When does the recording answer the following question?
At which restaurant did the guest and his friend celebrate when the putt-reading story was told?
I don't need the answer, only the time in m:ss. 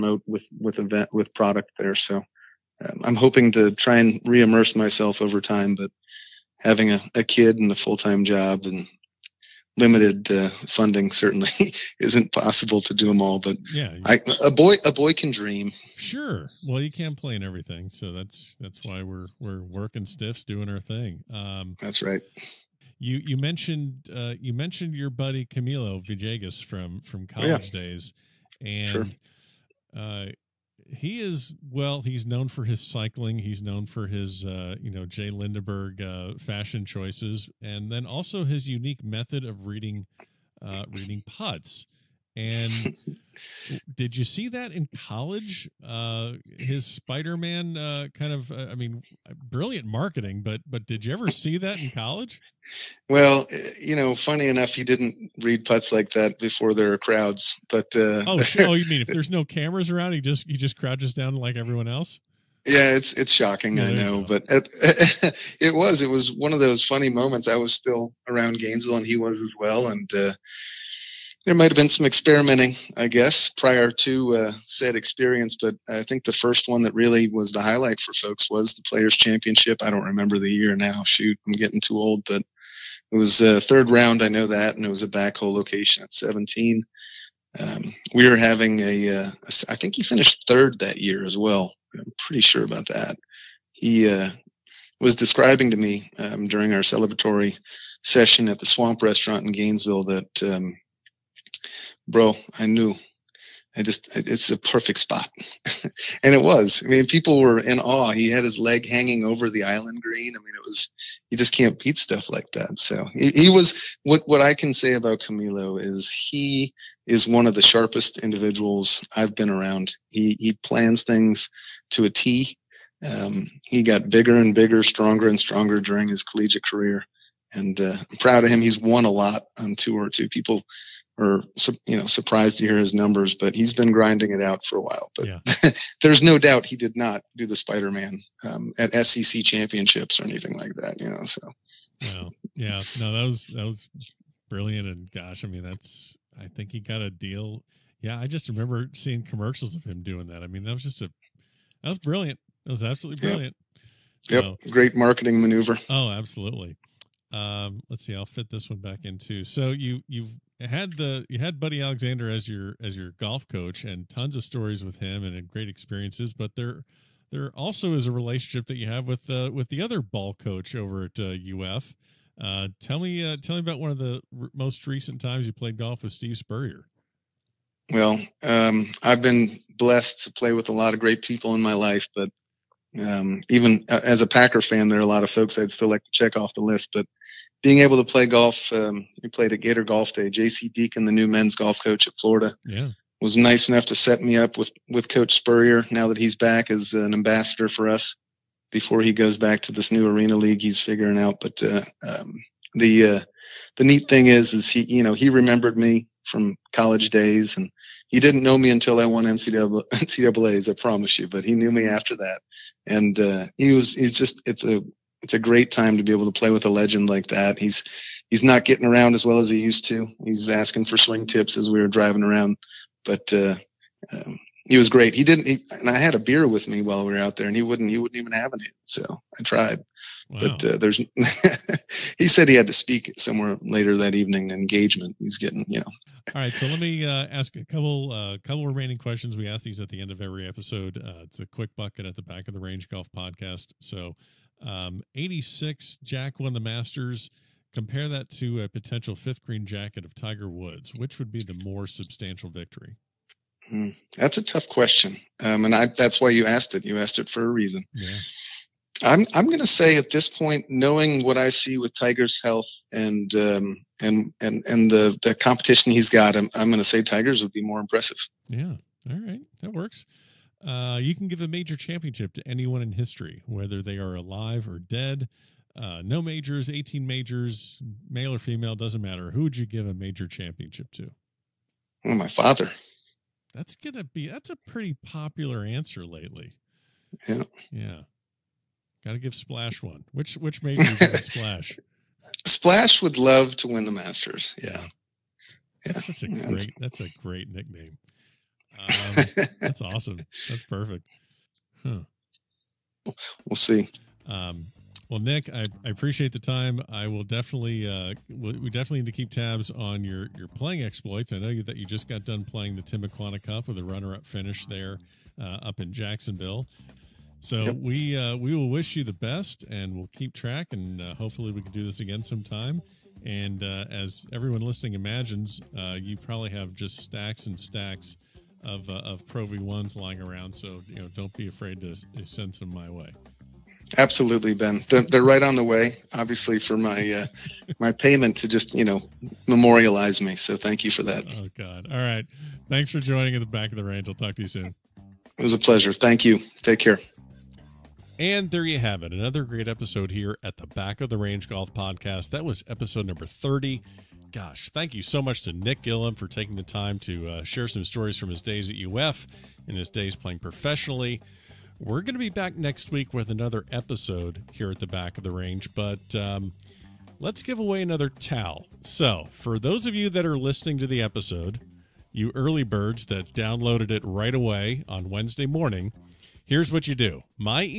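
1:38.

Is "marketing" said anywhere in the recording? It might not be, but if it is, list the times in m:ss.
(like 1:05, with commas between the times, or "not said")
0:49, 2:34.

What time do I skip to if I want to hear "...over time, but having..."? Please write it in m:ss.
0:05.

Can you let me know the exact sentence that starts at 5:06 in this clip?
I will definitely uh, we definitely need to keep tabs on your your playing exploits.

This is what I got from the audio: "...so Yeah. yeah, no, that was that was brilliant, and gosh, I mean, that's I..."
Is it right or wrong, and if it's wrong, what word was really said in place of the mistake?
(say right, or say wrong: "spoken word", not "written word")
right.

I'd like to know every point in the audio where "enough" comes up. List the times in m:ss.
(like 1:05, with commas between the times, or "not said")
0:54, 3:13.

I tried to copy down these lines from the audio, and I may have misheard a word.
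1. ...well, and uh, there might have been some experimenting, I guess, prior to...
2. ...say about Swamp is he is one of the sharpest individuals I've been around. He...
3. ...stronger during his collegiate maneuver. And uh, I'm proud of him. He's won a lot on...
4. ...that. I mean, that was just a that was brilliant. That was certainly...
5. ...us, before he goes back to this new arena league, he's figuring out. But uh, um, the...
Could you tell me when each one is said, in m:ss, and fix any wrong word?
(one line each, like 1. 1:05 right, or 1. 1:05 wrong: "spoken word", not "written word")
1. 1:09 right
2. 1:54 wrong: "Camilo", not "Swamp"
3. 2:05 wrong: "career", not "maneuver"
4. 2:30 wrong: "absolutely", not "certainly"
5. 3:17 right.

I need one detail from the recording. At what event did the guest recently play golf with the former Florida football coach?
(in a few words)
Gator Golf Day.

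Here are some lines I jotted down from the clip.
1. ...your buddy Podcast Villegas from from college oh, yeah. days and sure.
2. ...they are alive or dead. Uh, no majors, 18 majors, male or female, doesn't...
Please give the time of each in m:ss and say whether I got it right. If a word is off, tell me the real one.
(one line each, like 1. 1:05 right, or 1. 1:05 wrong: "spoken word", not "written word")
1. 0:24 wrong: "Camilo", not "Podcast"
2. 4:33 right.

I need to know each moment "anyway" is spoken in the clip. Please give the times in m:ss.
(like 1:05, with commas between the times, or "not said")
not said.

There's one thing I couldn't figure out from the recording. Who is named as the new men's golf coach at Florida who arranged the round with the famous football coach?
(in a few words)
J.C. Deaton.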